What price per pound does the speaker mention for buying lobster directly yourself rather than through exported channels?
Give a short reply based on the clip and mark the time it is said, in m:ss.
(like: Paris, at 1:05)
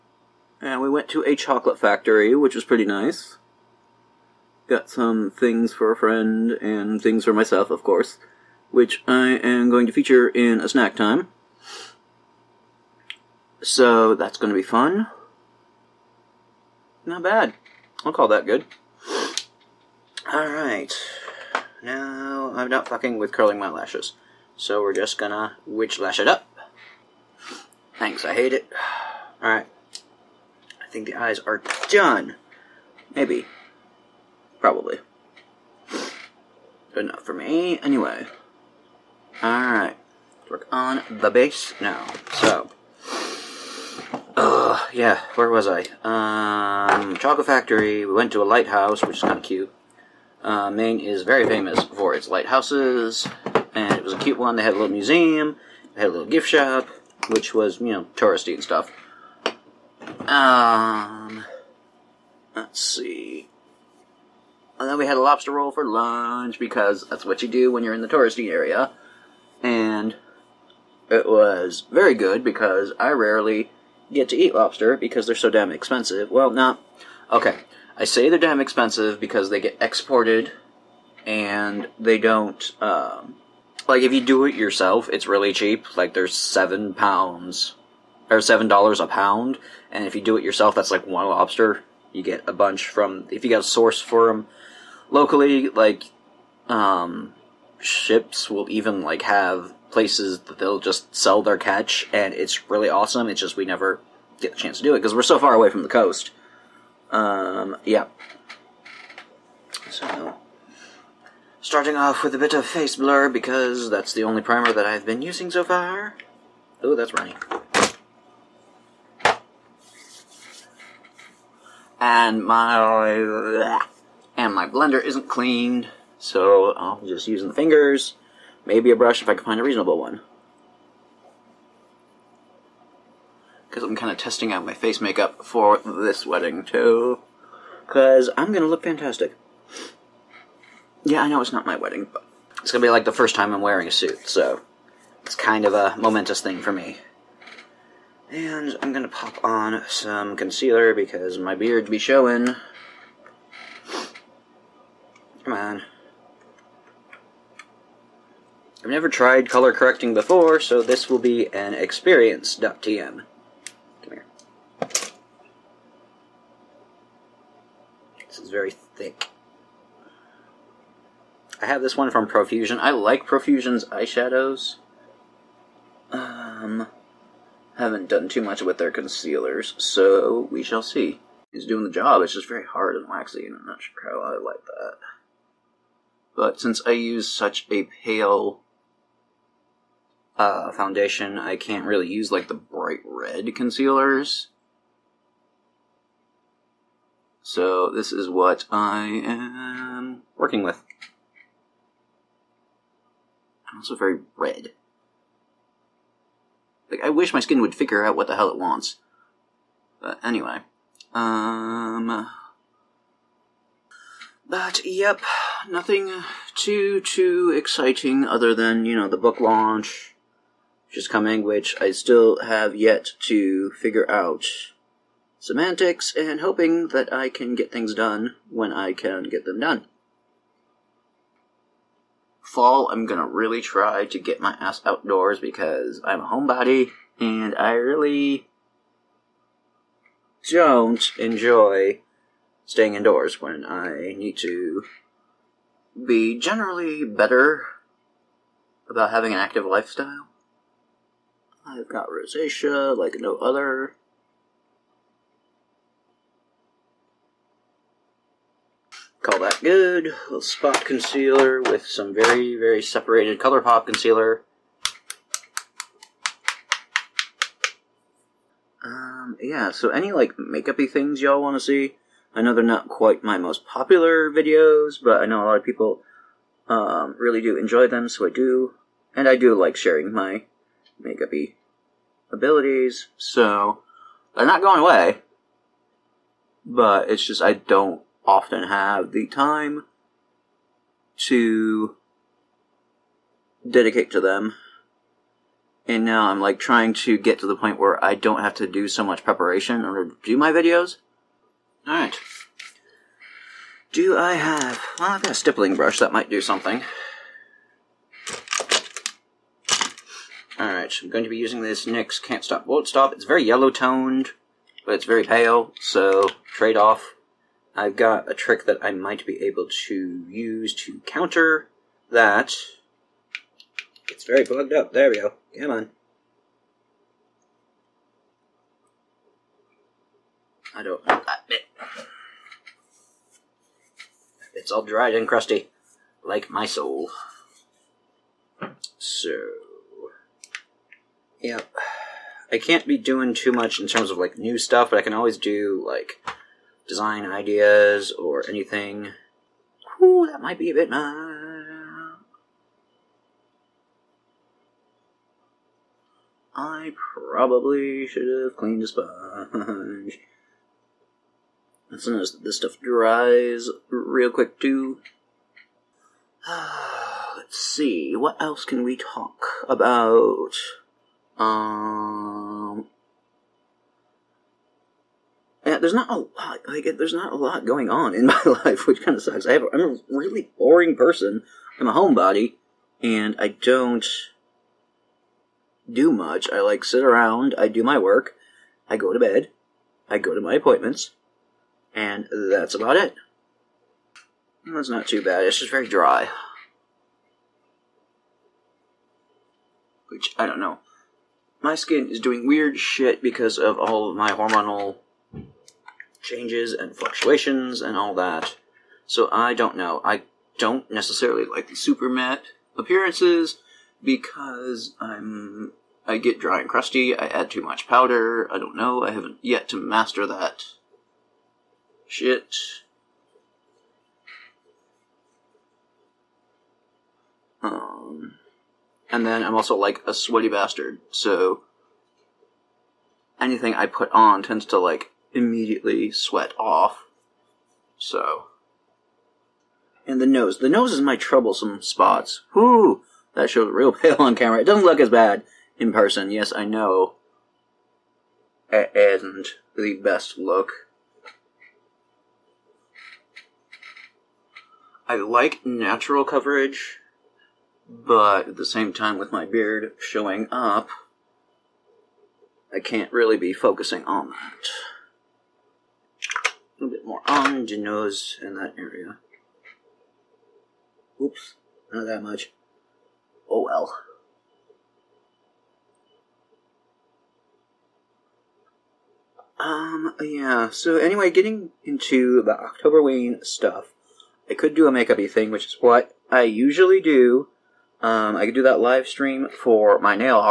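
$7, at 1:28.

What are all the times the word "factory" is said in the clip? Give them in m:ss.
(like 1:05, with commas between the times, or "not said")
0:01, 0:47.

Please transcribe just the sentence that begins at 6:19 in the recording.
I have, I'm a really boring person.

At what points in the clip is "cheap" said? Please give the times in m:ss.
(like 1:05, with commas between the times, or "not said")
1:25.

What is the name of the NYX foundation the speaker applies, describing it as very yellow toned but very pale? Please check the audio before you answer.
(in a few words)
Can't Stop Won't Stop.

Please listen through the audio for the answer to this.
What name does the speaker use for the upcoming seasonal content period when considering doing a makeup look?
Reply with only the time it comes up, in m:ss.
8:02.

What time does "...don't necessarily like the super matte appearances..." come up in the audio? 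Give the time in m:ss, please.
6:50.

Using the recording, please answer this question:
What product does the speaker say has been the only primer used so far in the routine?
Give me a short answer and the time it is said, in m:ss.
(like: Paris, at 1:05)
face blur, at 1:52.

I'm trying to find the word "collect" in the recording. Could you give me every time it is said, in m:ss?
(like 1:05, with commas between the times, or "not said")
not said.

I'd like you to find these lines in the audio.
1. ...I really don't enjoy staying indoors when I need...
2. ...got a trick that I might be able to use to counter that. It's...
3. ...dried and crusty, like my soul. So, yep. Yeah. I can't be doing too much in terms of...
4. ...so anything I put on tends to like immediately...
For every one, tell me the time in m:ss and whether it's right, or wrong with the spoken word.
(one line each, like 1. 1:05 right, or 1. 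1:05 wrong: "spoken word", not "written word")
1. 3:57 right
2. 5:17 right
3. 5:34 right
4. 7:11 right.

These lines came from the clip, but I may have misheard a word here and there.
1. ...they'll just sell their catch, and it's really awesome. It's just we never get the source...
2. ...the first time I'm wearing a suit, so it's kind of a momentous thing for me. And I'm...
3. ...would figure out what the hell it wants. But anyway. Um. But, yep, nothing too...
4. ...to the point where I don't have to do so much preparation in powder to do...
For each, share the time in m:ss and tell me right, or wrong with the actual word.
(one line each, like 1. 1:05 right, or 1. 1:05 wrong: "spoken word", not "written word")
1. 1:40 wrong: "chance", not "source"
2. 2:23 right
3. 3:27 right
4. 4:57 wrong: "order", not "powder".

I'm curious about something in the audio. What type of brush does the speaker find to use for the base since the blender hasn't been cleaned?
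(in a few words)
stippling brush.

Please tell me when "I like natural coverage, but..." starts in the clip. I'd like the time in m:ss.
7:35.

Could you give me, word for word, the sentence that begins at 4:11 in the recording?
I've got rosacea like no other.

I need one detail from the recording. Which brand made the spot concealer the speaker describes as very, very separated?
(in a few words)
ColourPop.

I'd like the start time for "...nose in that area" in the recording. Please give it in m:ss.
7:47.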